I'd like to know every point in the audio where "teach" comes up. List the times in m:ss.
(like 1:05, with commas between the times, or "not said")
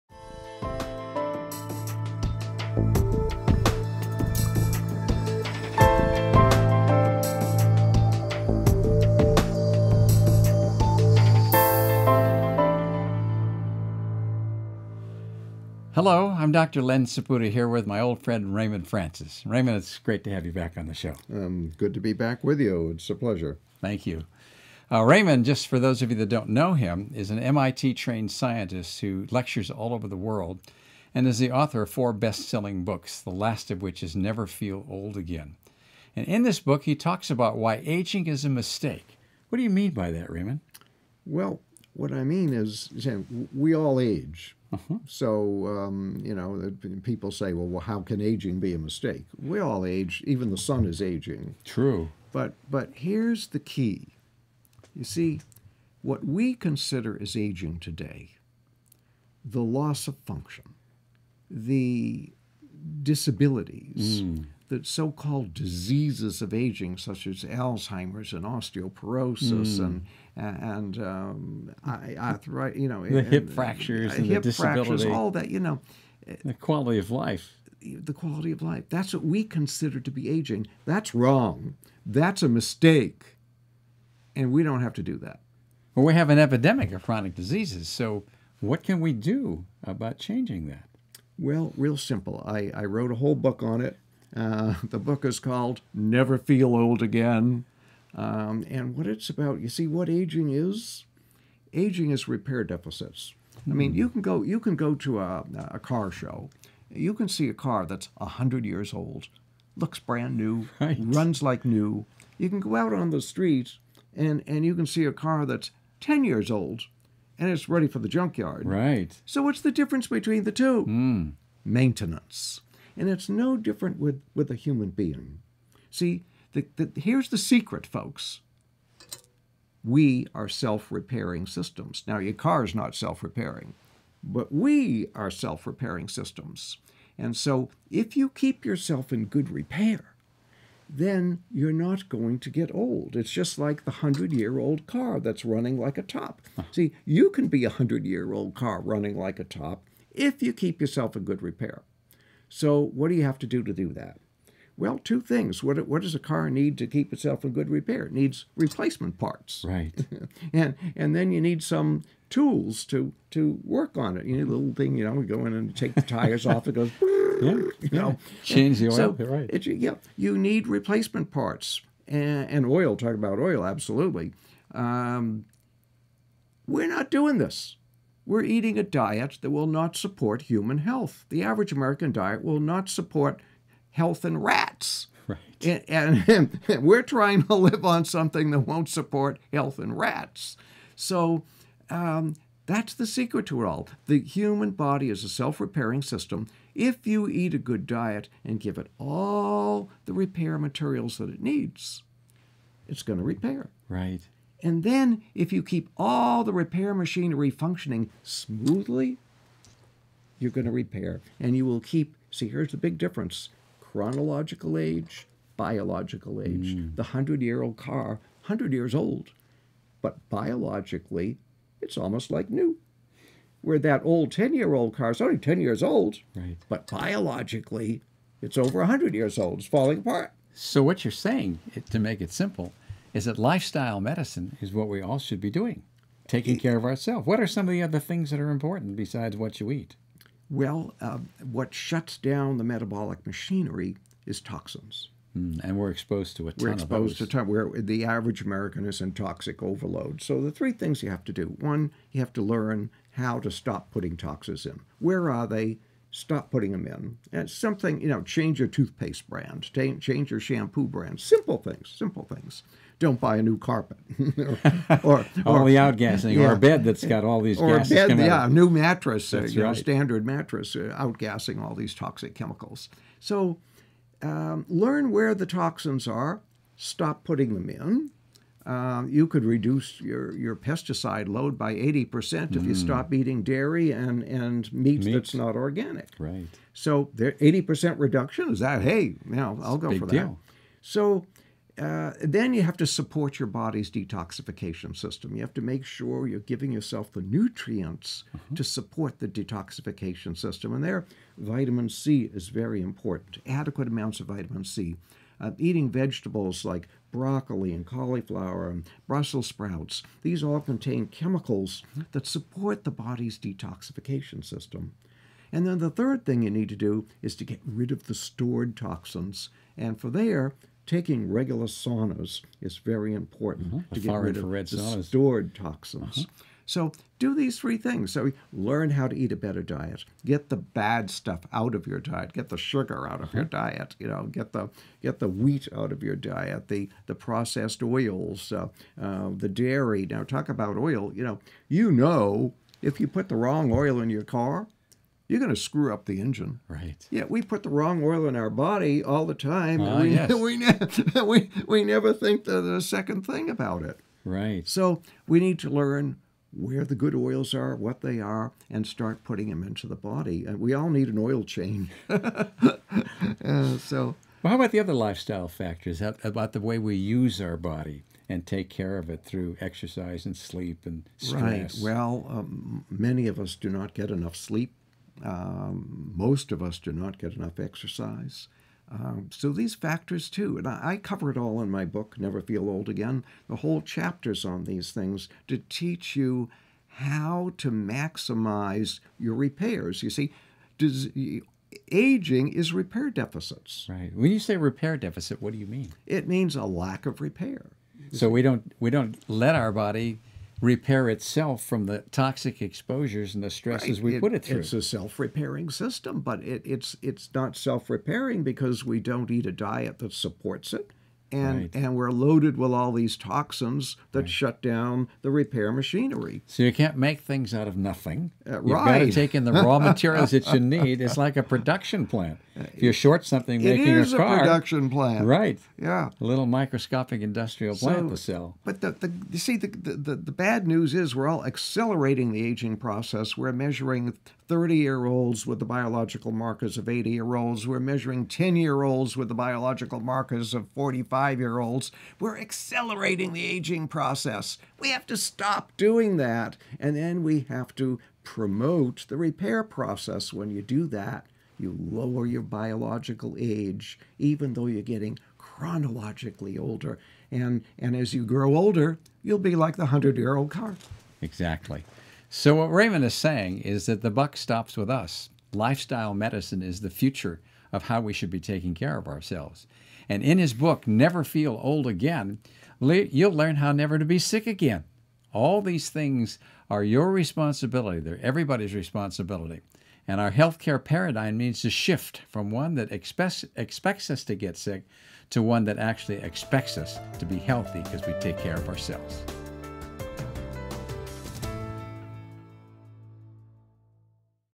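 6:25.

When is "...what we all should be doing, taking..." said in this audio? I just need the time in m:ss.
3:54.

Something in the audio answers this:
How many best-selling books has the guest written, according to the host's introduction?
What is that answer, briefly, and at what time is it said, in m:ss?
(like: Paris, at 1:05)
4, at 0:31.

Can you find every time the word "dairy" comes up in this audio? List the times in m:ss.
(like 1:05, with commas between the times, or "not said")
4:43, 5:39.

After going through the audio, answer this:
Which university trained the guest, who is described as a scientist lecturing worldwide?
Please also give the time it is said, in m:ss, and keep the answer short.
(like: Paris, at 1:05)
MIT, at 0:27.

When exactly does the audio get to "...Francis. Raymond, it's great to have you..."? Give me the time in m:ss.
0:18.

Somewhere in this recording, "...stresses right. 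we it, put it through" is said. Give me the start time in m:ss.
6:43.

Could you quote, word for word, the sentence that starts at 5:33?
You know, get the get the wheat out of your diet.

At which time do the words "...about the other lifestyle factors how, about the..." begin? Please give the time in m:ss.
6:04.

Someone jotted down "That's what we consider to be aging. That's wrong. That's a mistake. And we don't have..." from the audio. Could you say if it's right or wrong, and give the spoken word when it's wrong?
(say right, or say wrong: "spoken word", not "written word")
right.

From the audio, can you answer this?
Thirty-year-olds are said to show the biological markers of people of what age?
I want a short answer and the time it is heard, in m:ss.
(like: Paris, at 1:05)
80, at 7:16.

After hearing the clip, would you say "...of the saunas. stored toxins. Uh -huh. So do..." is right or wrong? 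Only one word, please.
right.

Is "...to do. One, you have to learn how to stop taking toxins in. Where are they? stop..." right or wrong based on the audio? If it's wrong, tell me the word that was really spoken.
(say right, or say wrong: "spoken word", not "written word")
wrong: "putting", not "taking".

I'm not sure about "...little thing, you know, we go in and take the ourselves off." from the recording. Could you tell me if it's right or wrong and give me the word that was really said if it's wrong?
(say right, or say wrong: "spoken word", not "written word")
wrong: "tires", not "ourselves".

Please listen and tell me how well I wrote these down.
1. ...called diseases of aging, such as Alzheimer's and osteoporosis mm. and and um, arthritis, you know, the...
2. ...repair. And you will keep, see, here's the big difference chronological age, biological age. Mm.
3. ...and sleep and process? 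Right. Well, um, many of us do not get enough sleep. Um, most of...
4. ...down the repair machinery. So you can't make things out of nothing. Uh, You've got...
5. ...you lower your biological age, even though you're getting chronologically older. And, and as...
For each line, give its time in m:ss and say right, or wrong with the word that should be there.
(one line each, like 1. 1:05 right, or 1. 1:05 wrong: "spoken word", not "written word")
1. 1:05 right
2. 3:30 right
3. 6:10 wrong: "stress", not "process"
4. 6:54 right
5. 7:31 right.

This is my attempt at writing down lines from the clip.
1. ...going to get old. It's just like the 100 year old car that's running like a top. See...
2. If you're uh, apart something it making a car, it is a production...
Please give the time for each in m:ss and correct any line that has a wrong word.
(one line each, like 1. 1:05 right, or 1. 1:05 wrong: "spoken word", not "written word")
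1. 2:22 right
2. 7:02 wrong: "short", not "apart".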